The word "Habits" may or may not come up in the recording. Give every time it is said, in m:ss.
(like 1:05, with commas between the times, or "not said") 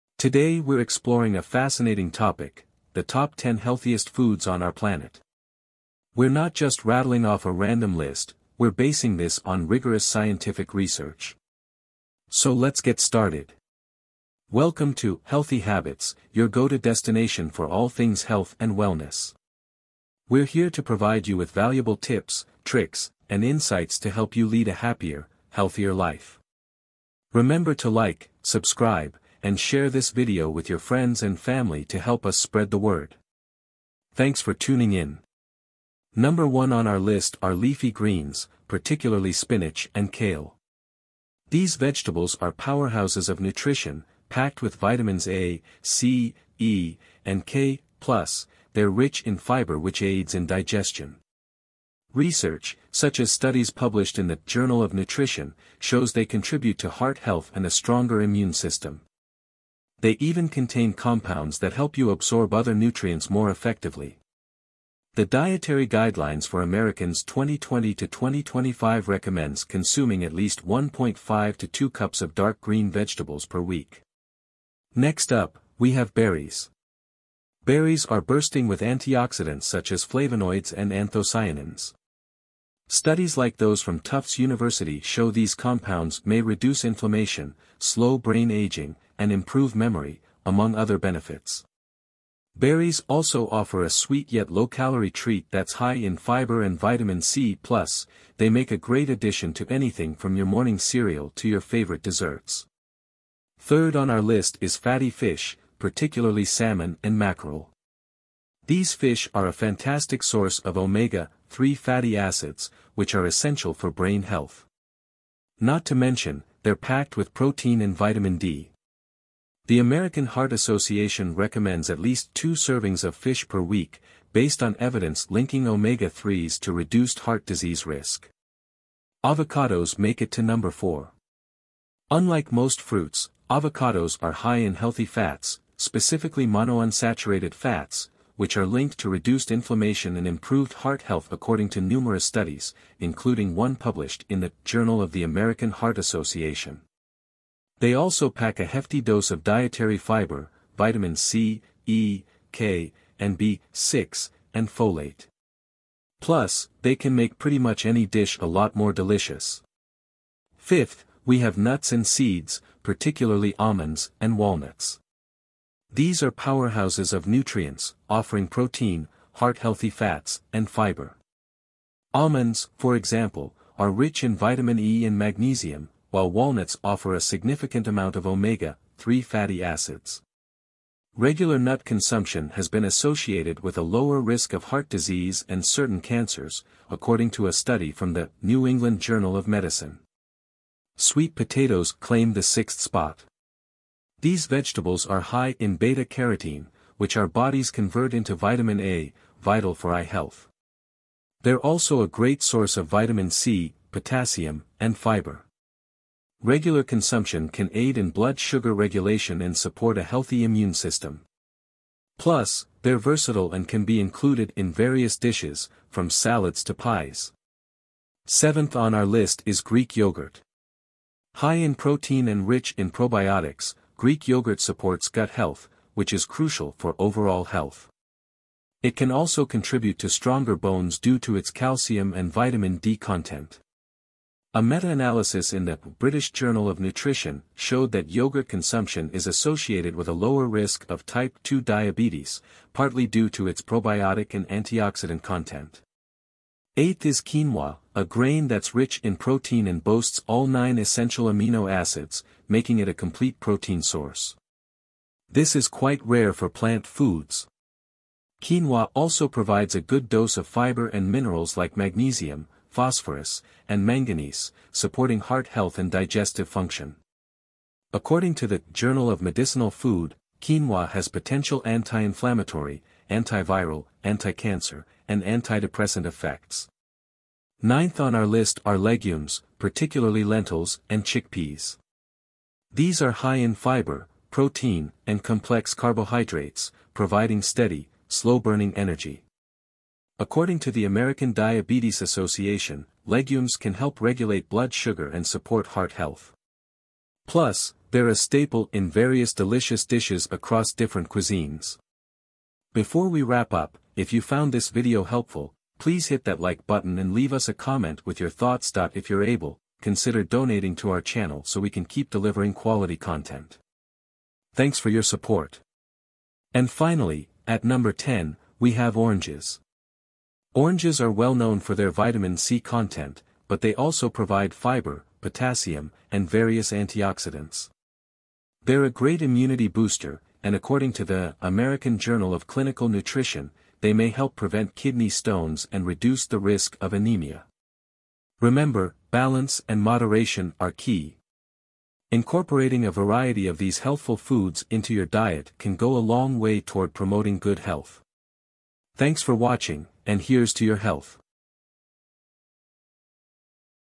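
0:15.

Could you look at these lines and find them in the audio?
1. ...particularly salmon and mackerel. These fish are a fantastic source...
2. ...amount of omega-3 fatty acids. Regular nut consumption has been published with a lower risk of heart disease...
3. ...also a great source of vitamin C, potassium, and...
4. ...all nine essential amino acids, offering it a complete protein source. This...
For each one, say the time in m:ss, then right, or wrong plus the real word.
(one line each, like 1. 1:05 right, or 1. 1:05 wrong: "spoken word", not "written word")
1. 1:45 right
2. 2:57 wrong: "associated", not "published"
3. 3:21 right
4. 4:10 wrong: "making", not "offering".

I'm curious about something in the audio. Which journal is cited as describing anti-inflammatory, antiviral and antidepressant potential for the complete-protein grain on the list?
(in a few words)
Journal of Medicinal Food.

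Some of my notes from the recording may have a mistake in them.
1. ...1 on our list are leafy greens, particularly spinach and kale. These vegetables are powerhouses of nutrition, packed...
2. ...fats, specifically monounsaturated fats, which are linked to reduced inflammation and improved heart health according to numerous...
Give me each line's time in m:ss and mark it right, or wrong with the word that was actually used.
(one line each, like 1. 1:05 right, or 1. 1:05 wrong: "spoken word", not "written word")
1. 0:36 right
2. 2:15 right.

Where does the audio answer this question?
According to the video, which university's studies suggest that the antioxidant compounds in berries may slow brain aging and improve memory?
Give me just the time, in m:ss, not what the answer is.
1:24.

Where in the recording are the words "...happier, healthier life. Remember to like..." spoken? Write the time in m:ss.
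0:24.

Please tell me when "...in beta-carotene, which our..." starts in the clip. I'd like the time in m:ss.
3:15.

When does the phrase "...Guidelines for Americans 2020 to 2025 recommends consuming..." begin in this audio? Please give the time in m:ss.
1:05.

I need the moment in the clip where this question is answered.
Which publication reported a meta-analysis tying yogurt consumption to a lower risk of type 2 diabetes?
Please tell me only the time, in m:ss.
3:55.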